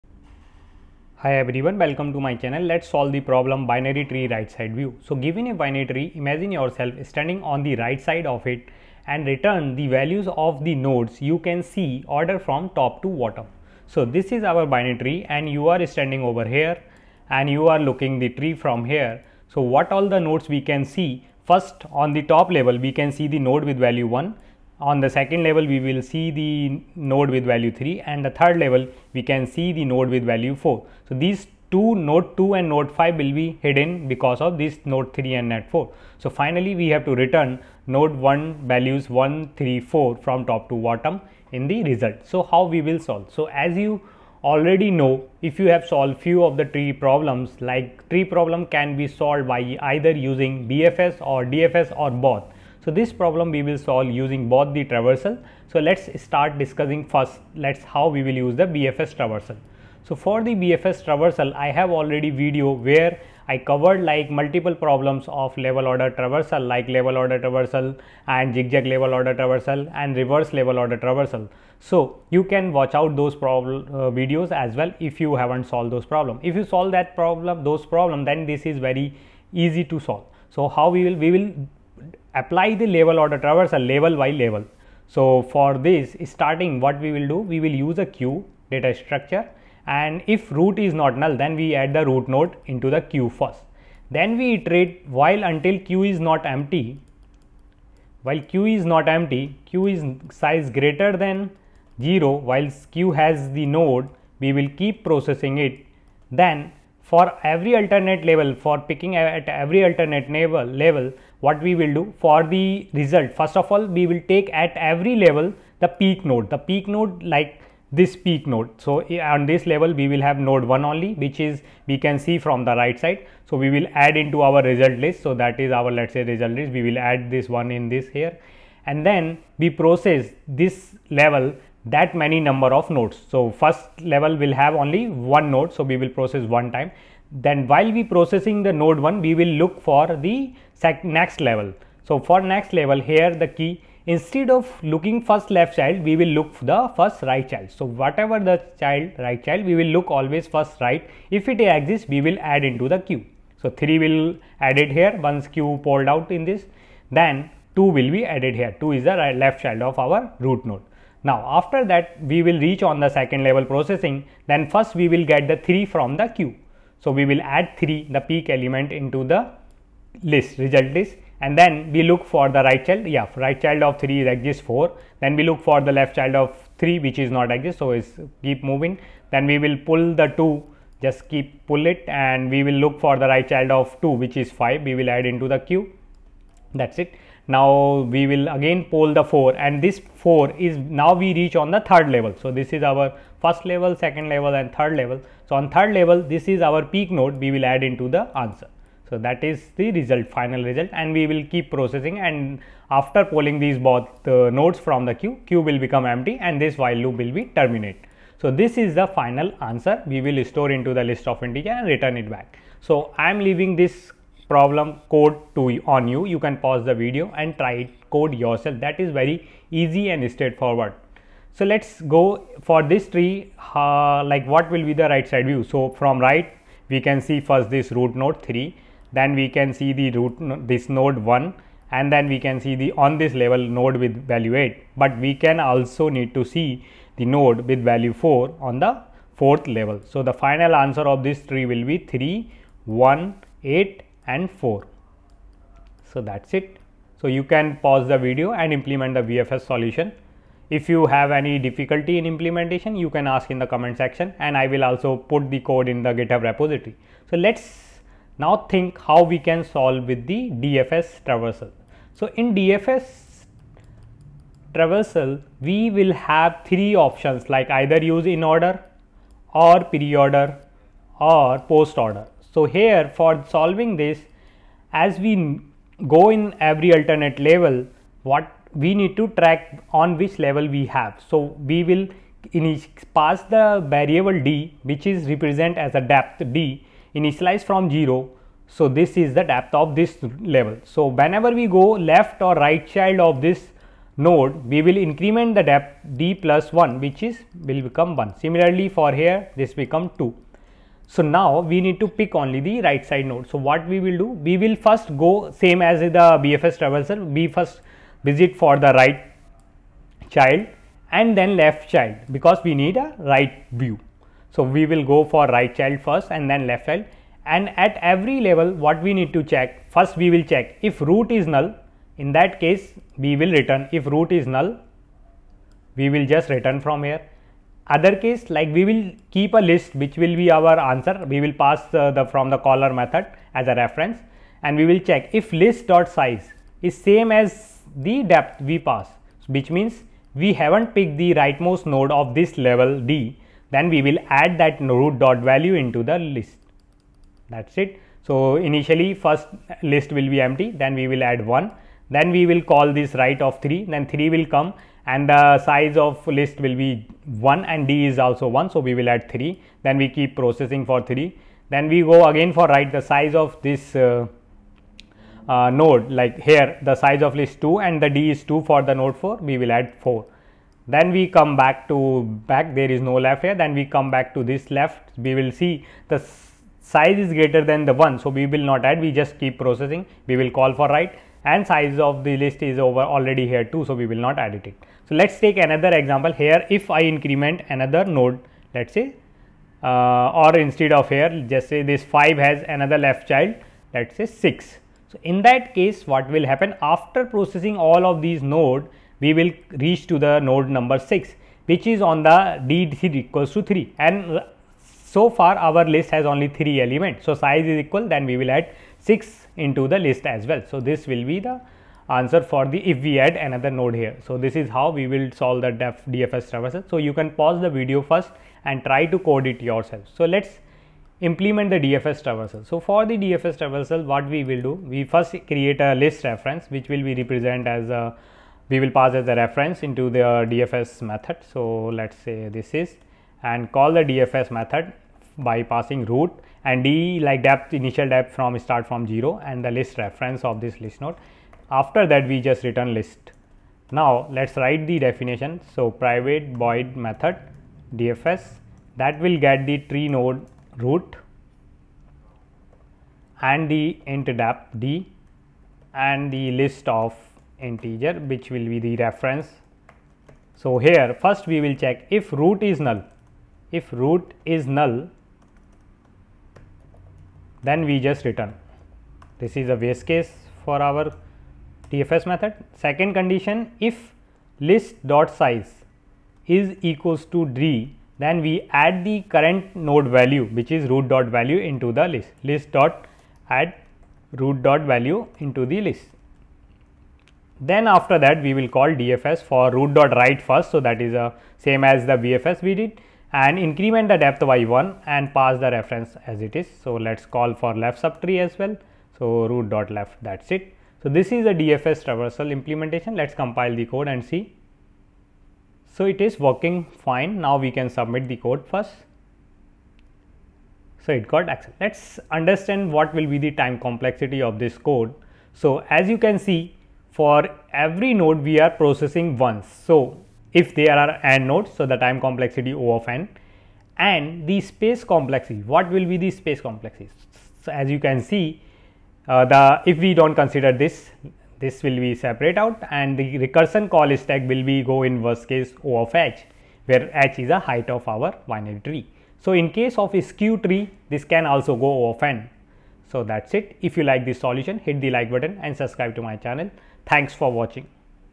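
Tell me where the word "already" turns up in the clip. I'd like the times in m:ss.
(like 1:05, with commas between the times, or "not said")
0:44, 1:01, 6:23.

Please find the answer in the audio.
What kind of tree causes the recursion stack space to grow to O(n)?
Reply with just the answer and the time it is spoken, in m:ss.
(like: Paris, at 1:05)
Skew tree, at 9:00.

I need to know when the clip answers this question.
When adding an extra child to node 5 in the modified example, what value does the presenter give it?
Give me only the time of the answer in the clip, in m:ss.
6:33.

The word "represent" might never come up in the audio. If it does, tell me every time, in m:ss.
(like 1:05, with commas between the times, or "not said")
4:45, 7:07.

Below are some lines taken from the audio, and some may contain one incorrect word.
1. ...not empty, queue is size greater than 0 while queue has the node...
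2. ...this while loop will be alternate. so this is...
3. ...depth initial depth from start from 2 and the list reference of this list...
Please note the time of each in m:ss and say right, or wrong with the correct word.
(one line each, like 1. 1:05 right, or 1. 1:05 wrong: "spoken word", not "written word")
1. 1:38 right
2. 3:26 wrong: "terminate", not "alternate"
3. 7:17 wrong: "0", not "2".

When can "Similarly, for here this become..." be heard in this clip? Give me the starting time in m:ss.
4:58.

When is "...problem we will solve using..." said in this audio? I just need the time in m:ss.
0:53.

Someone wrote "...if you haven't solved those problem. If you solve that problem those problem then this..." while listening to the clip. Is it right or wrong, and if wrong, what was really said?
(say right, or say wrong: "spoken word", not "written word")
right.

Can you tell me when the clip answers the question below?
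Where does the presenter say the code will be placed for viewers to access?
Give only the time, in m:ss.
4:16.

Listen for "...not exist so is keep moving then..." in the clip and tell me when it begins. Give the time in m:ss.
2:57.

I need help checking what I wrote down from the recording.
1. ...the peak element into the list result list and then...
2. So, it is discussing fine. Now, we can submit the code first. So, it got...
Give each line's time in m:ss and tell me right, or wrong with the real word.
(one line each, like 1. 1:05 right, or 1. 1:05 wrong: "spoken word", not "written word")
1. 2:48 right
2. 8:25 wrong: "working", not "discussing".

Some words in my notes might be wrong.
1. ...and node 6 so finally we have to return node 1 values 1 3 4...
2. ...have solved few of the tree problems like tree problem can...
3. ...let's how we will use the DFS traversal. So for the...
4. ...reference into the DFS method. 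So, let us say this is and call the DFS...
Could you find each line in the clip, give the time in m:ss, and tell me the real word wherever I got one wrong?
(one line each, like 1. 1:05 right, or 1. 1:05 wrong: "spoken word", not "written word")
1. 0:35 wrong: "4", not "6"
2. 0:45 right
3. 0:57 wrong: "BFS", not "DFS"
4. 7:09 right.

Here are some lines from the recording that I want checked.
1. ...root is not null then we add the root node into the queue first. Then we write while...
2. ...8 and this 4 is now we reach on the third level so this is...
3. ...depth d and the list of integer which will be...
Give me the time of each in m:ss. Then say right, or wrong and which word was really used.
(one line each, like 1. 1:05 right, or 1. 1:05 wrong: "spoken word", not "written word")
1. 1:30 wrong: "iterate", not "write"
2. 3:09 wrong: "4", not "8"
3. 7:34 right.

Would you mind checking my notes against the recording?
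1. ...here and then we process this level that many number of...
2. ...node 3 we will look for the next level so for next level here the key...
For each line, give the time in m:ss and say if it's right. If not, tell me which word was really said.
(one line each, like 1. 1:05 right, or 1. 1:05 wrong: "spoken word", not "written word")
1. 2:08 right
2. 2:18 wrong: "1", not "3".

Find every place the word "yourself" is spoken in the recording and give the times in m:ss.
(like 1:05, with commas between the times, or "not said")
0:06, 3:38, 6:59.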